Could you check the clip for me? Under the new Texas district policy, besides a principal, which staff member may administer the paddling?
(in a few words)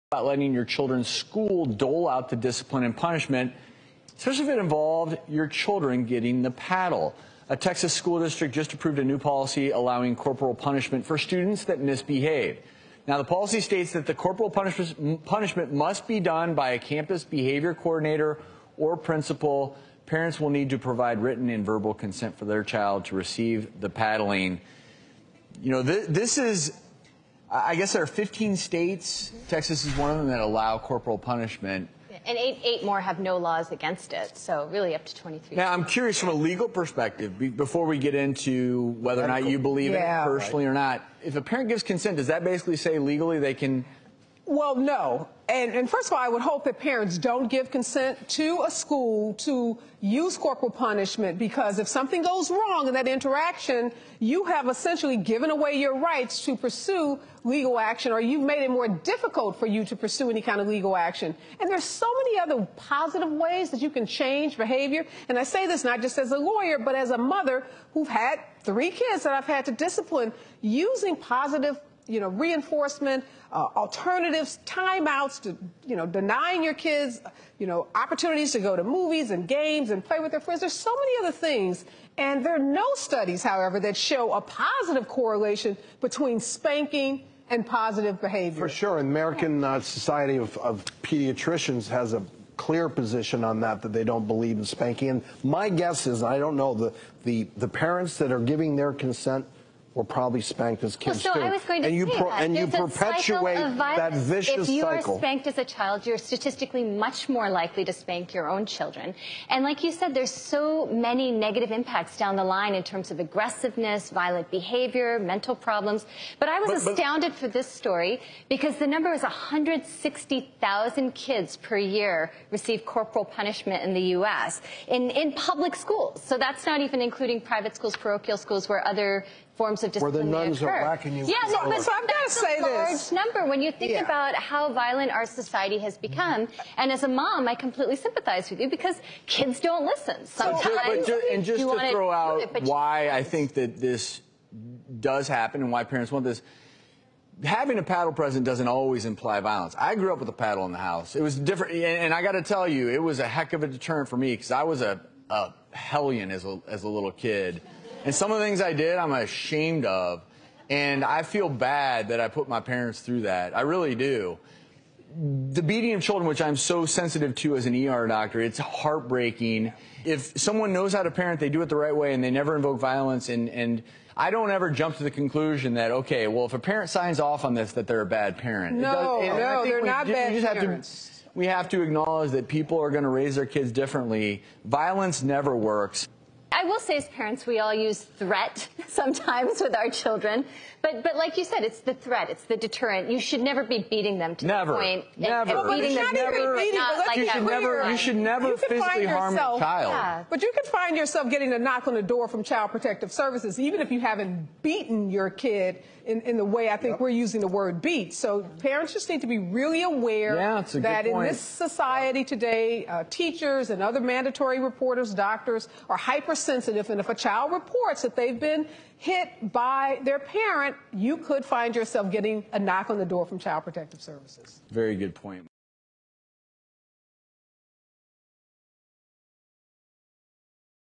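campus behavior coordinator.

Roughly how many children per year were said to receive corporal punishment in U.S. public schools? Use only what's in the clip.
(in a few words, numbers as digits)
160,000.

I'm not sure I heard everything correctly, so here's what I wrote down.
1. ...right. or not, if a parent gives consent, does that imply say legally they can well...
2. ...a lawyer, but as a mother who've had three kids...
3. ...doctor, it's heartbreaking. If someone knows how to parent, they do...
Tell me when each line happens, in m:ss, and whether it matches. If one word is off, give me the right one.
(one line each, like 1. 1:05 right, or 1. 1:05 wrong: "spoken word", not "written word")
1. 0:40 wrong: "basically", not "imply"
2. 1:06 right
3. 2:48 right.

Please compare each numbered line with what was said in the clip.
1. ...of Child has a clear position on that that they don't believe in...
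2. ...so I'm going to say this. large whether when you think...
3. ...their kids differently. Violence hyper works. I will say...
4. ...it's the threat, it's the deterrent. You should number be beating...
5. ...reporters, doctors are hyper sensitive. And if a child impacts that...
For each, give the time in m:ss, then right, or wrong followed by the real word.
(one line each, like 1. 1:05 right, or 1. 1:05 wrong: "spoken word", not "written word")
1. 1:30 wrong: "Pediatricians", not "Child"
2. 2:11 wrong: "number", not "whether"
3. 3:03 wrong: "never", not "hyper"
4. 3:11 wrong: "never", not "number"
5. 3:34 wrong: "reports", not "impacts".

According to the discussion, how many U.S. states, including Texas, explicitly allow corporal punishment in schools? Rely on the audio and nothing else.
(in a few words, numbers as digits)
15.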